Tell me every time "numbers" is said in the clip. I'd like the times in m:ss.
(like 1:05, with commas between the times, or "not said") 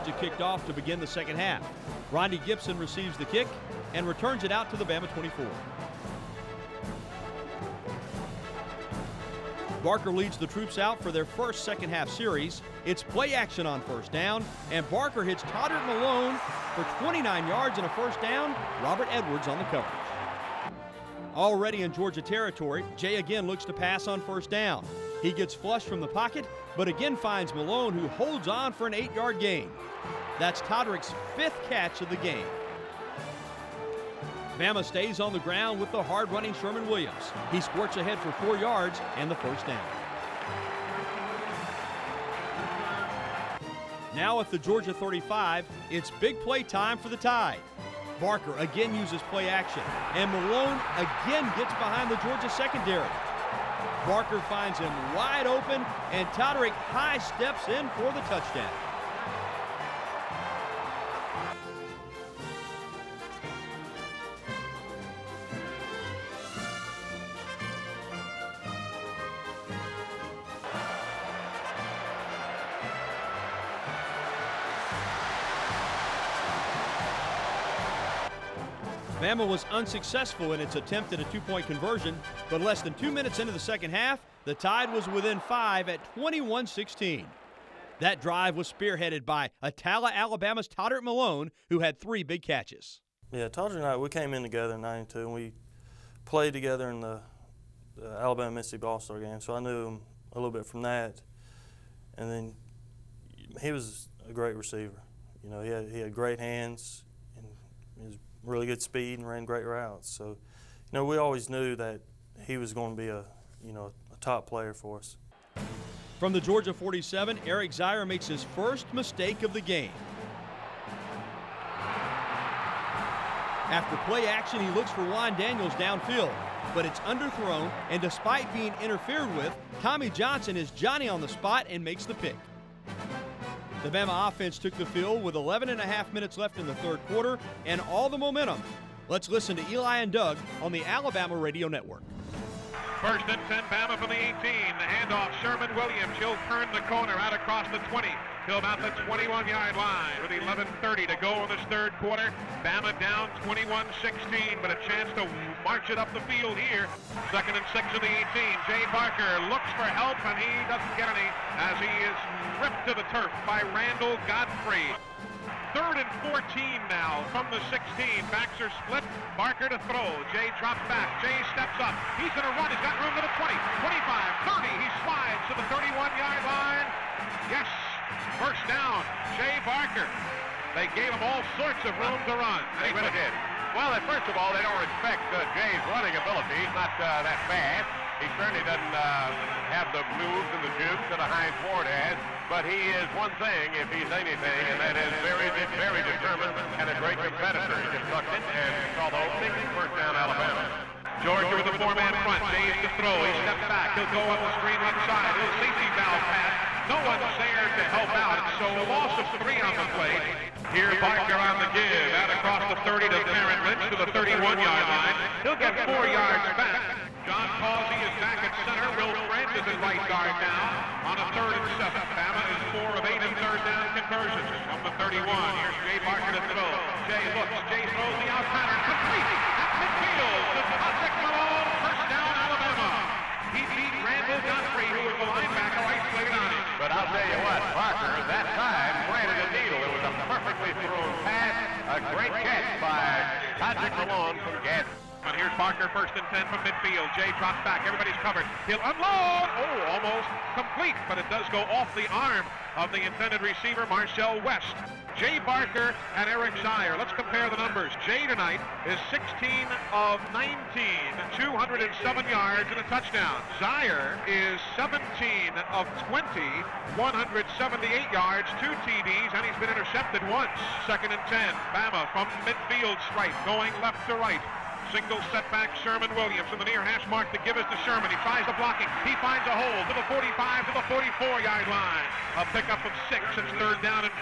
4:17.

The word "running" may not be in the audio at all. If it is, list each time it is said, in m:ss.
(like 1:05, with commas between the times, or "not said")
0:36, 3:05.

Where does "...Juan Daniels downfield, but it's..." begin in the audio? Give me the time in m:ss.
2:05.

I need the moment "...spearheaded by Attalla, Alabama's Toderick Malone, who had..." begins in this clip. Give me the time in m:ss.
1:28.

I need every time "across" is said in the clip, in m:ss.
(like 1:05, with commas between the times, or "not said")
2:27, 3:32.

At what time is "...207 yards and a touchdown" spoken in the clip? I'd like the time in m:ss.
4:21.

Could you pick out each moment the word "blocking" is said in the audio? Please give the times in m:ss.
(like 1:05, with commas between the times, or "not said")
4:38.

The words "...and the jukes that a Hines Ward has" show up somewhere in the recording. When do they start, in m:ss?
3:10.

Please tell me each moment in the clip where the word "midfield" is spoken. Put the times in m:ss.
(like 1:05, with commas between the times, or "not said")
3:49, 4:06, 4:32.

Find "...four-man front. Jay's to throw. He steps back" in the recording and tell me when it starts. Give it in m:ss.
3:21.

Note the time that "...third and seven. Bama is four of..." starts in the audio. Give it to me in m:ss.
3:41.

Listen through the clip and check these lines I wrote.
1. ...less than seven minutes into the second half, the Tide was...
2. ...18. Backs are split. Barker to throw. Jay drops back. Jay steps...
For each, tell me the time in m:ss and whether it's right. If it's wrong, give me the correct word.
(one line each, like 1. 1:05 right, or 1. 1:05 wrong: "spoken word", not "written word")
1. 1:22 wrong: "two", not "seven"
2. 2:47 wrong: "16", not "18".